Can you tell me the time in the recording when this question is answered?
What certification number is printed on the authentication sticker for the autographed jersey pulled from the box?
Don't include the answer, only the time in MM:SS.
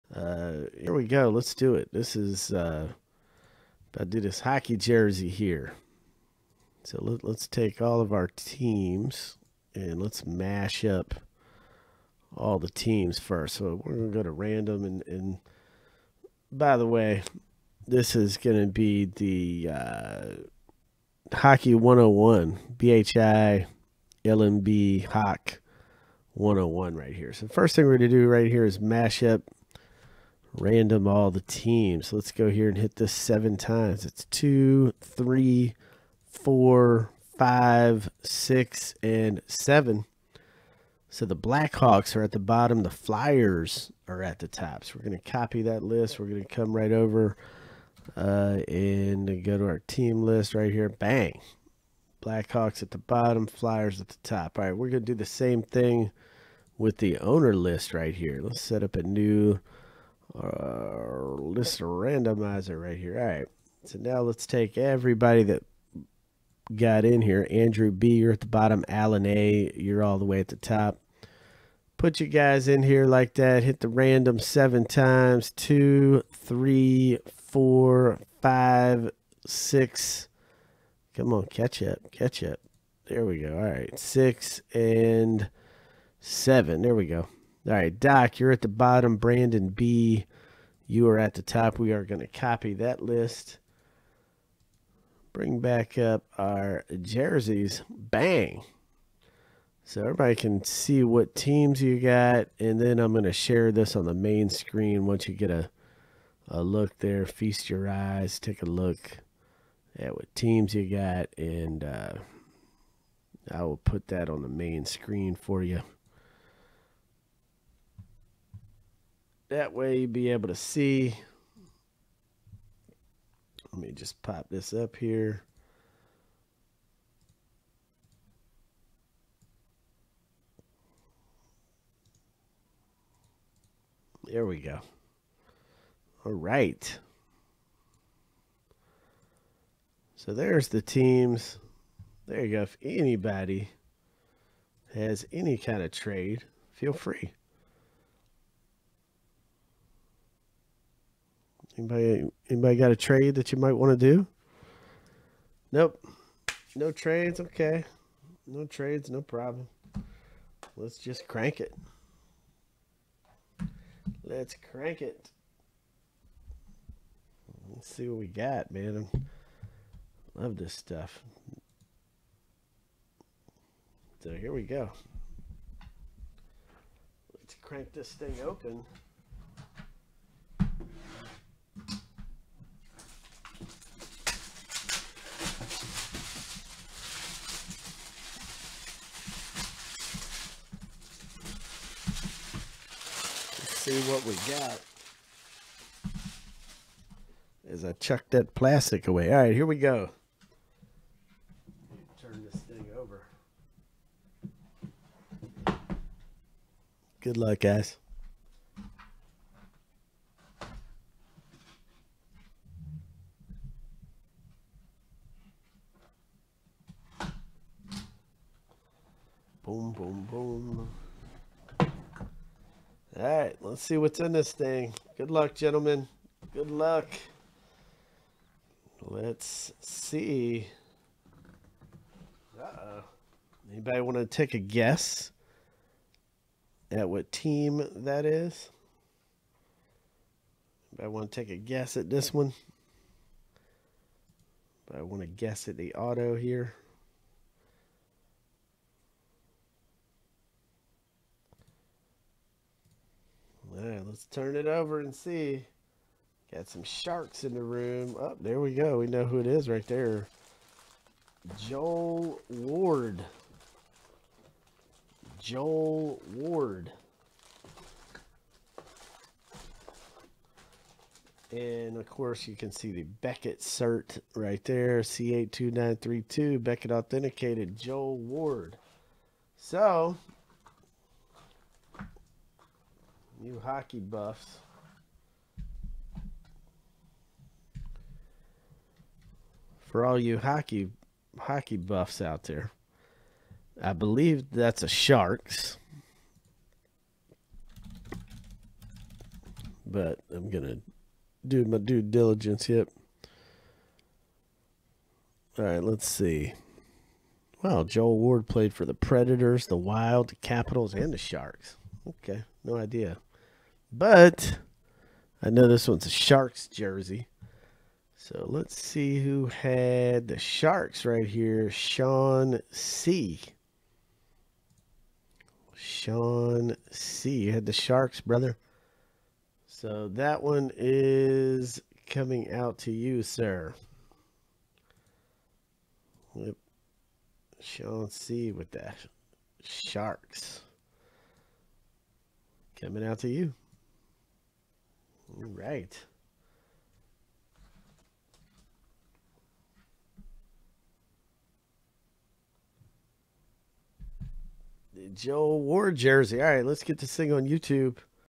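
04:35.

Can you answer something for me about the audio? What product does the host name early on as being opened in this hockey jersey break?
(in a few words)
Hockey 101.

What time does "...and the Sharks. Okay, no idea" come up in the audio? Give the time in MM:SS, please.
05:10.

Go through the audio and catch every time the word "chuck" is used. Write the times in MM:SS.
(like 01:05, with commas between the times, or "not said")
03:17.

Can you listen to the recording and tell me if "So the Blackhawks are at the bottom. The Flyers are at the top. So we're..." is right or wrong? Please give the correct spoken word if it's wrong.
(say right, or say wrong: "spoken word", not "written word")
right.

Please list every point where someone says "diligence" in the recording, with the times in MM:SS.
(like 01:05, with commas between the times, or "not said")
05:02.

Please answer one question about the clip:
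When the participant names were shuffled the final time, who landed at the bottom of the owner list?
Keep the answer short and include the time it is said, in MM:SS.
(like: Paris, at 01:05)
Doc, at 01:27.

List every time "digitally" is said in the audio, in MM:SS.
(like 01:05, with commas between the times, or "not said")
not said.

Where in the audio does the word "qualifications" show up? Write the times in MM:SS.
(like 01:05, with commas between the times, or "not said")
not said.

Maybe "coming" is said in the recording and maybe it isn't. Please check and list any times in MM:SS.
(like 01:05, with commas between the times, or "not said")
05:32, 05:42.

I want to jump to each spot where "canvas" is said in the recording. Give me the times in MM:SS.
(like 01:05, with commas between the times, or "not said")
not said.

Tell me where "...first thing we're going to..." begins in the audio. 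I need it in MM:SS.
00:27.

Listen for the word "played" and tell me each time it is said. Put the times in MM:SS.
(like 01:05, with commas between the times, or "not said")
05:08.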